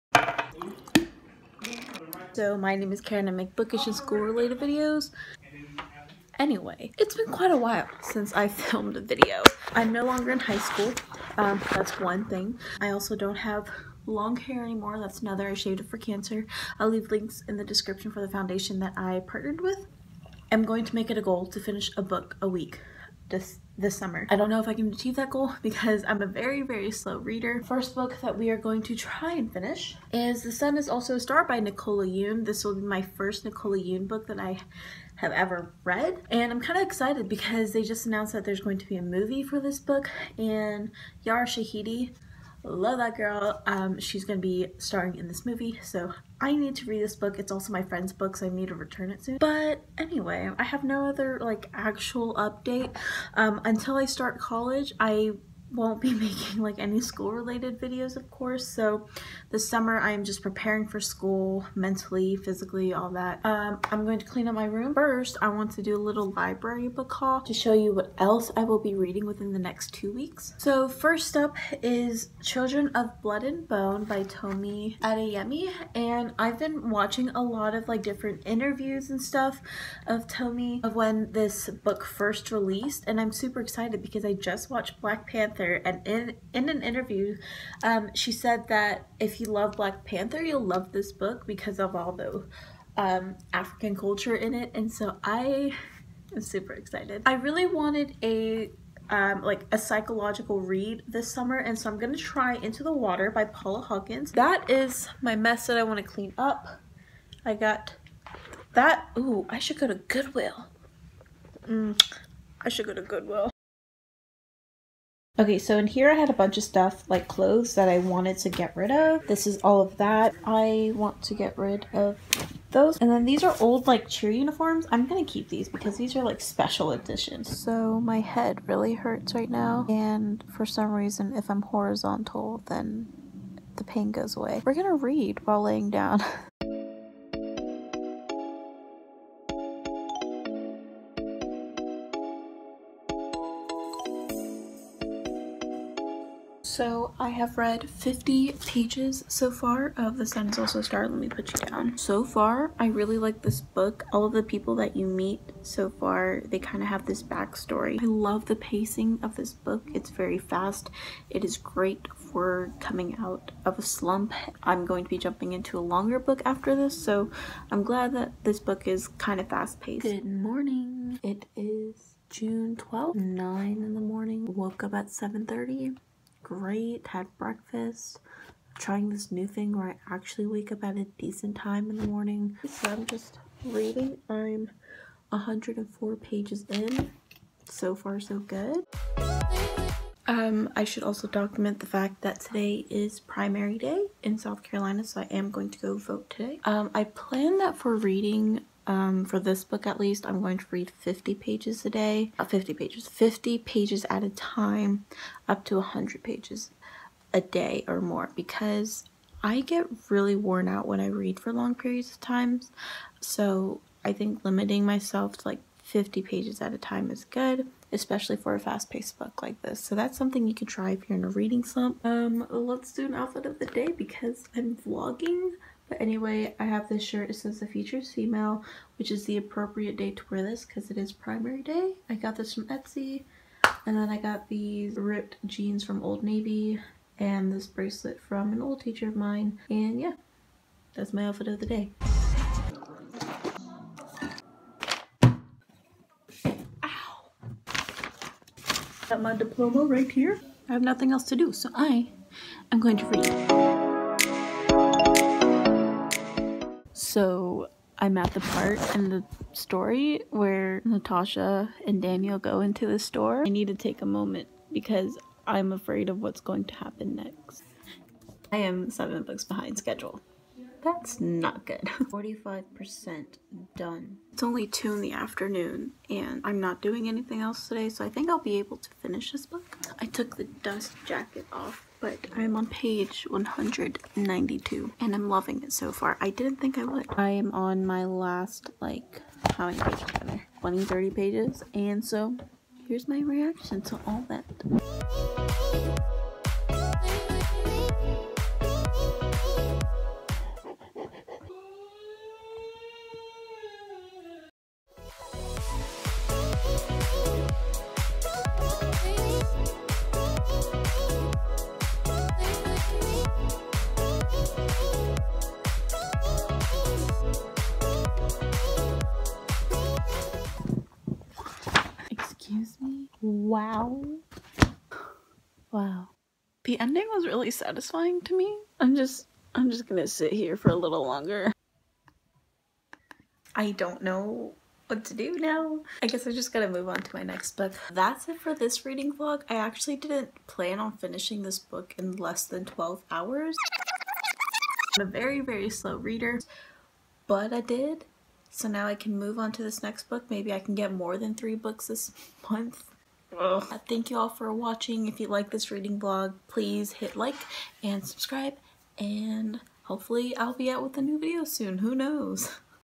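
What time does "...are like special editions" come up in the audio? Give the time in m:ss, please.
2:06.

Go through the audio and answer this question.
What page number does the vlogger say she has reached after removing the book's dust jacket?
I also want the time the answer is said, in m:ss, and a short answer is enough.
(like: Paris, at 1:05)
192, at 4:42.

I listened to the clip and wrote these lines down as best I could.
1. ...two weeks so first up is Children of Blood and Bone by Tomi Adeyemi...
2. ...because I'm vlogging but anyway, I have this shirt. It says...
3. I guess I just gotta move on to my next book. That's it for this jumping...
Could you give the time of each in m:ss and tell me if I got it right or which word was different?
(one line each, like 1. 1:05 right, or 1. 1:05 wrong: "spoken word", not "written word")
1. 1:09 right
2. 3:43 right
3. 5:36 wrong: "reading", not "jumping".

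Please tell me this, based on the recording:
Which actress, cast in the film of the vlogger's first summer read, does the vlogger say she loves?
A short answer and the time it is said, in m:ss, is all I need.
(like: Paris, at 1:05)
Yara Shahidi, at 0:41.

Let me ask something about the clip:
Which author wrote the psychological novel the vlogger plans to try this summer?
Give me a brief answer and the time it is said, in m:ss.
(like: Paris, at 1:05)
Paula Hawkins, at 1:43.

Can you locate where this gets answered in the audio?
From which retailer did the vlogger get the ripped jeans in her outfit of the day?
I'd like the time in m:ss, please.
3:56.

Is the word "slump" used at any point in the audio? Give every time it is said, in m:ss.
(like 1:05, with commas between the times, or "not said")
2:43, 3:41.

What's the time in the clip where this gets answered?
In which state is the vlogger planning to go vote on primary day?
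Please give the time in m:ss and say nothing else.
3:14.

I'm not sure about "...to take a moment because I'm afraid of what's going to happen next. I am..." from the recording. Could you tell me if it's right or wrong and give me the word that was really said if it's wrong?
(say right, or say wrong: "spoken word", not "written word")
right.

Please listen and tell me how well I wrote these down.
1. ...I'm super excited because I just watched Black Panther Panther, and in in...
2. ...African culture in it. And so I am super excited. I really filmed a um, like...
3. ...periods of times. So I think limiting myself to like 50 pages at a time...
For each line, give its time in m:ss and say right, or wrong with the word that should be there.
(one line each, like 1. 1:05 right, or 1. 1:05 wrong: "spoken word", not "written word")
1. 1:23 right
2. 1:33 wrong: "wanted", not "filmed"
3. 3:31 right.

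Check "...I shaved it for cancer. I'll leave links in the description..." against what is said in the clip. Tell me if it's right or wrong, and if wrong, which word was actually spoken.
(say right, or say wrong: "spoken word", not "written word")
right.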